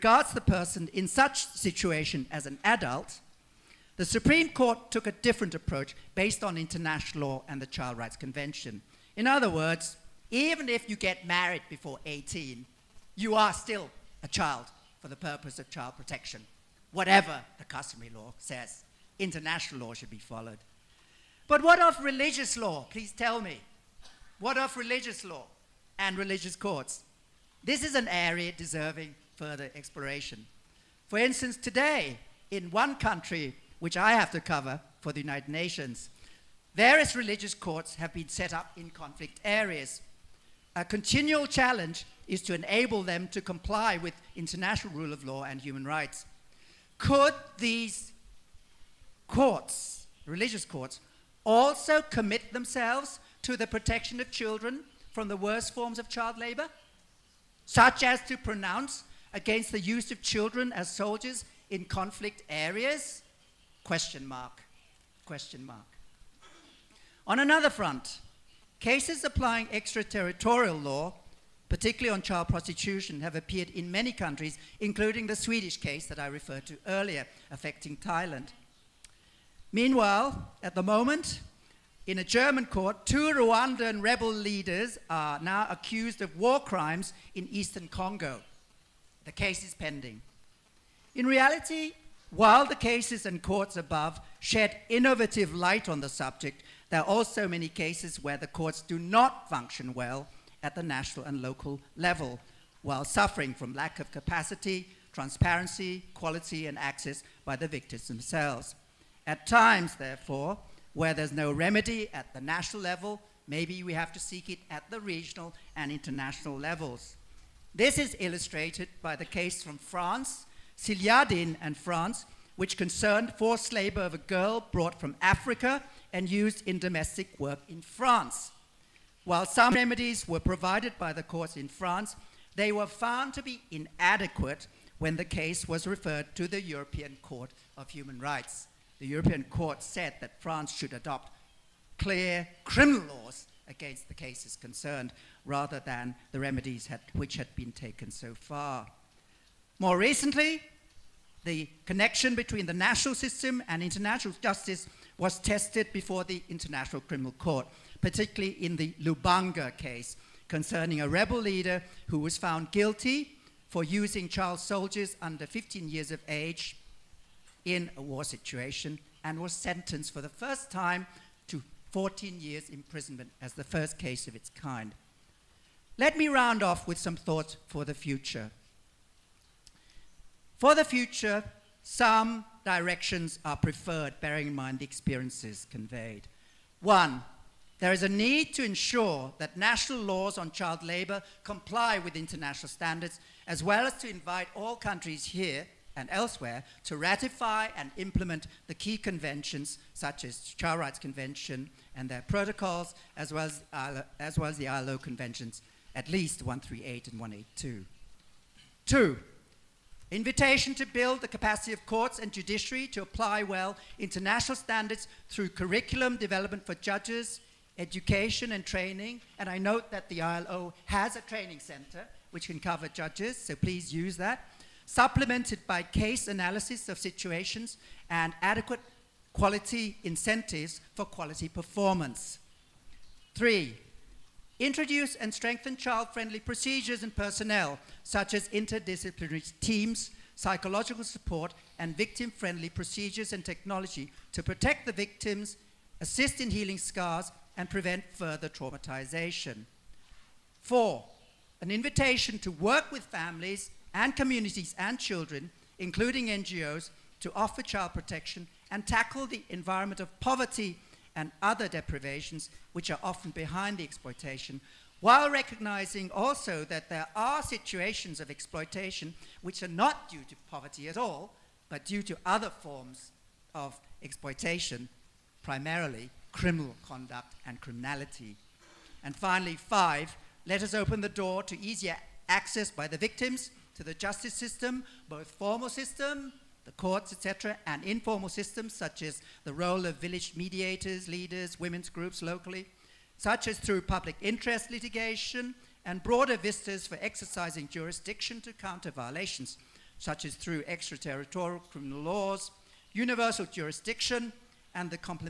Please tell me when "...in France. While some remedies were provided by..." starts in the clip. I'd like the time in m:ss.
2:07.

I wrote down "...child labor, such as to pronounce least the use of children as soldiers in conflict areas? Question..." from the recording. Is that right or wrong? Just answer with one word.
wrong.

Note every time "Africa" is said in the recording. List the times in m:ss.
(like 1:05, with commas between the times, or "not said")
2:05.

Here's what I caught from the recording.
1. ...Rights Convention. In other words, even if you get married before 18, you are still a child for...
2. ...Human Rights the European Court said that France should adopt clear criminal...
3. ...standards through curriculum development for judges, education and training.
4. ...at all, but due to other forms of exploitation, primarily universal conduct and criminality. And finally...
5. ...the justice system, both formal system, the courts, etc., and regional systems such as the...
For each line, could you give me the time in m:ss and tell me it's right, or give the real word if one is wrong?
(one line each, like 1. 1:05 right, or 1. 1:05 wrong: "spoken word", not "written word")
1. 0:07 right
2. 2:17 right
3. 3:34 right
4. 4:30 wrong: "criminal", not "universal"
5. 4:43 wrong: "informal", not "regional".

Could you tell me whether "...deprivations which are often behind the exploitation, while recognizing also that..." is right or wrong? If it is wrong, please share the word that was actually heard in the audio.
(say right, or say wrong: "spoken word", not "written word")
right.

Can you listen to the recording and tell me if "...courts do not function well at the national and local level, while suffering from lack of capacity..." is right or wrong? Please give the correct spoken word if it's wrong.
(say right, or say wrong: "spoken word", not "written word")
right.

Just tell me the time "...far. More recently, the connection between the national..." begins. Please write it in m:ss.
2:28.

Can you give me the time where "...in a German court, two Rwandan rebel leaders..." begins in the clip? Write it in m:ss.
1:22.